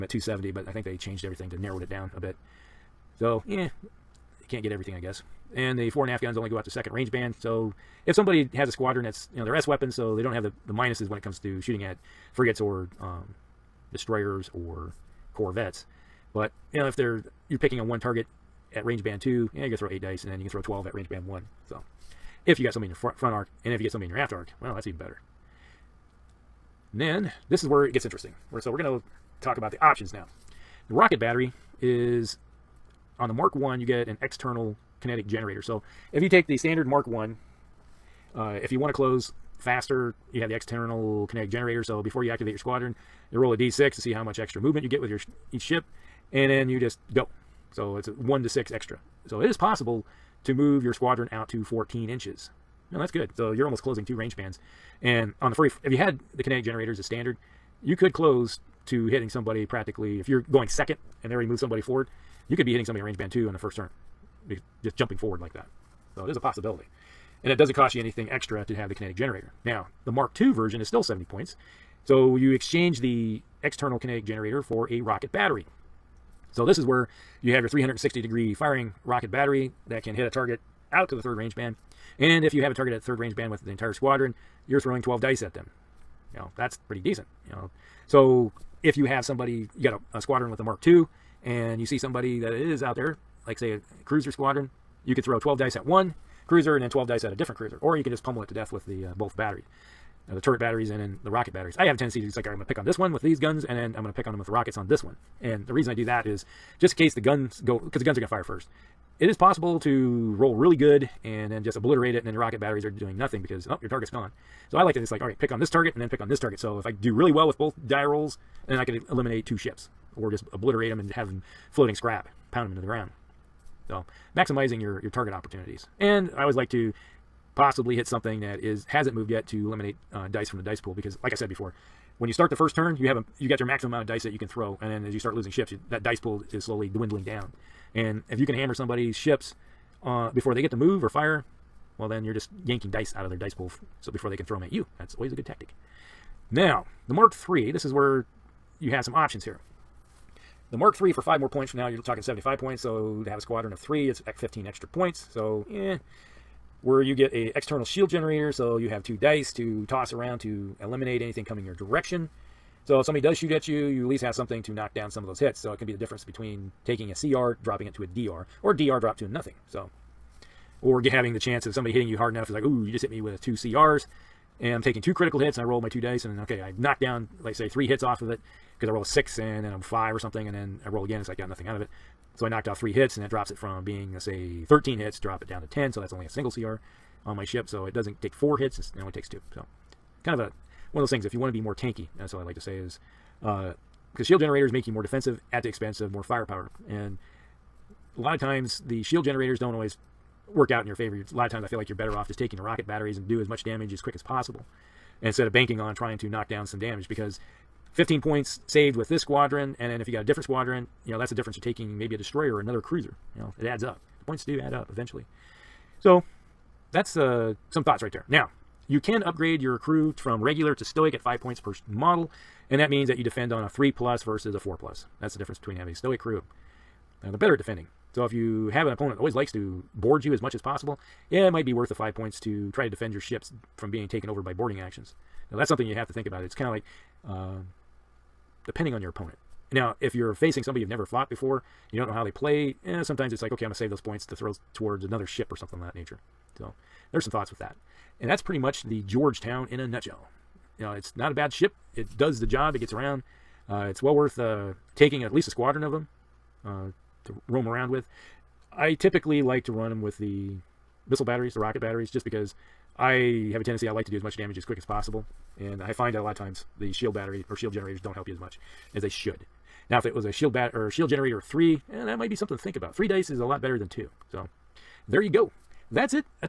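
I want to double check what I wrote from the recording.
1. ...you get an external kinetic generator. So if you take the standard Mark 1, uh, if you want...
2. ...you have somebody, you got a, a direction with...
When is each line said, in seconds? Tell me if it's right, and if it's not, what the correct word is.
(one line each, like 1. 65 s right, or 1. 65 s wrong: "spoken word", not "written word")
1. 33 s right
2. 88 s wrong: "squadron", not "direction".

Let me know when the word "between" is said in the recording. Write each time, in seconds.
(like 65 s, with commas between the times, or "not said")
166 s, 225 s.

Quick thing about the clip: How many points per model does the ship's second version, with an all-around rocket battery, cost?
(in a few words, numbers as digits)
70.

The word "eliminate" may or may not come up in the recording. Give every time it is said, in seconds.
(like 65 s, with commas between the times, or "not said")
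119 s, 129 s, 160 s.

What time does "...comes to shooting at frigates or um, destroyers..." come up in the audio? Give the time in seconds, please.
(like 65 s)
11 s.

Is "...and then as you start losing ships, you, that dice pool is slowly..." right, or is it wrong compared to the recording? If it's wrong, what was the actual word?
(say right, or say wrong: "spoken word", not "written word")
right.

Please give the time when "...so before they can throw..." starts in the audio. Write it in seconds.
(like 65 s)
144 s.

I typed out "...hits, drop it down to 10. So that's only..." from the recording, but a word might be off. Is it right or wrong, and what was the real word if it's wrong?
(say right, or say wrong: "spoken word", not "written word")
right.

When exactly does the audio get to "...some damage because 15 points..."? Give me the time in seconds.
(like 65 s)
206 s.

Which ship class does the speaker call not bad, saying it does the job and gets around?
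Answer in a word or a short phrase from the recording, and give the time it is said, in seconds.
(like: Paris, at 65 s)
Georgetown, at 249 s.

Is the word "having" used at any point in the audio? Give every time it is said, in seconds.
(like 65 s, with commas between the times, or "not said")
171 s, 225 s.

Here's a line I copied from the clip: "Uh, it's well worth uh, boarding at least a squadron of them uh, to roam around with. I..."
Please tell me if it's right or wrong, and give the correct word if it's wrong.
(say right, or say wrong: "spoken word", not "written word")
wrong: "taking", not "boarding".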